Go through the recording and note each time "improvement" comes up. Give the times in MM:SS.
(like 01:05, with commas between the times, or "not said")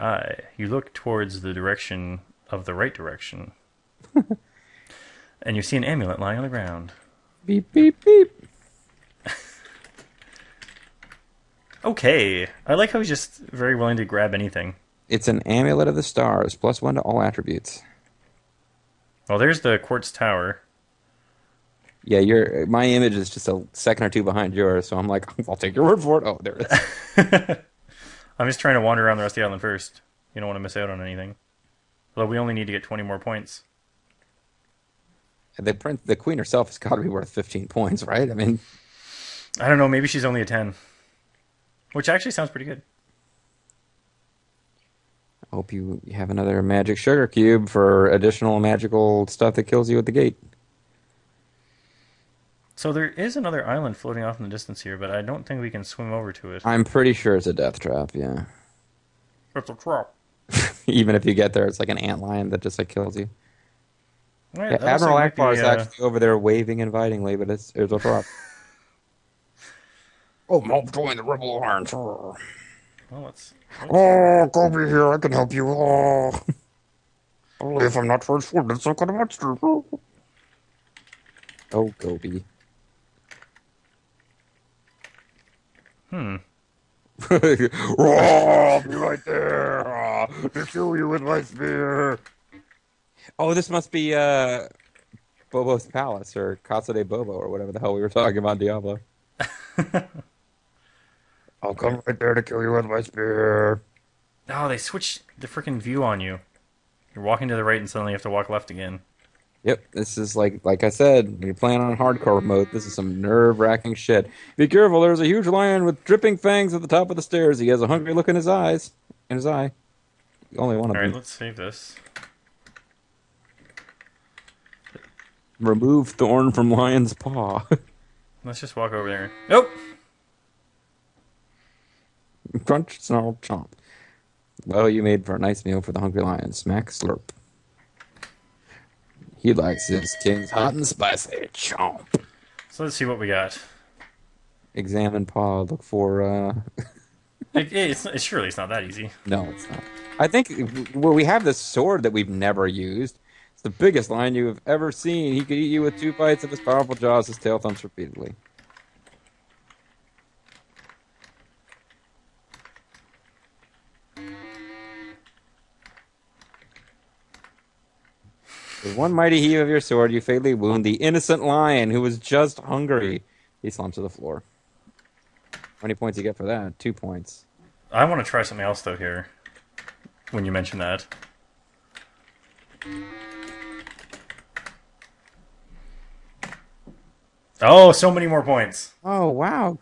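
not said.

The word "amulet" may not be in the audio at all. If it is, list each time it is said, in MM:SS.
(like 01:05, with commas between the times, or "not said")
00:05, 00:15.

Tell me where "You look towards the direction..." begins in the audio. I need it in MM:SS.
00:00.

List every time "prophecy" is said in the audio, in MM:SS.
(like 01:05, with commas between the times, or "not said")
not said.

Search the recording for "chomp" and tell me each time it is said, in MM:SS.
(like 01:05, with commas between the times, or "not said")
02:13, 02:21.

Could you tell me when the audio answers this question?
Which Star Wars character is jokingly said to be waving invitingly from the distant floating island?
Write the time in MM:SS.
01:04.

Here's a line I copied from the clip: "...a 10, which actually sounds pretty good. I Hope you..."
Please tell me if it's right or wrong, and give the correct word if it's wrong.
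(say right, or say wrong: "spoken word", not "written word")
right.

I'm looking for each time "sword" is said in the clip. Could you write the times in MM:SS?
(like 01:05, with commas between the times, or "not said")
02:31, 02:49.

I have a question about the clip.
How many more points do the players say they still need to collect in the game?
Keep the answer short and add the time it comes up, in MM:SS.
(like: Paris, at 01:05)
20, at 00:32.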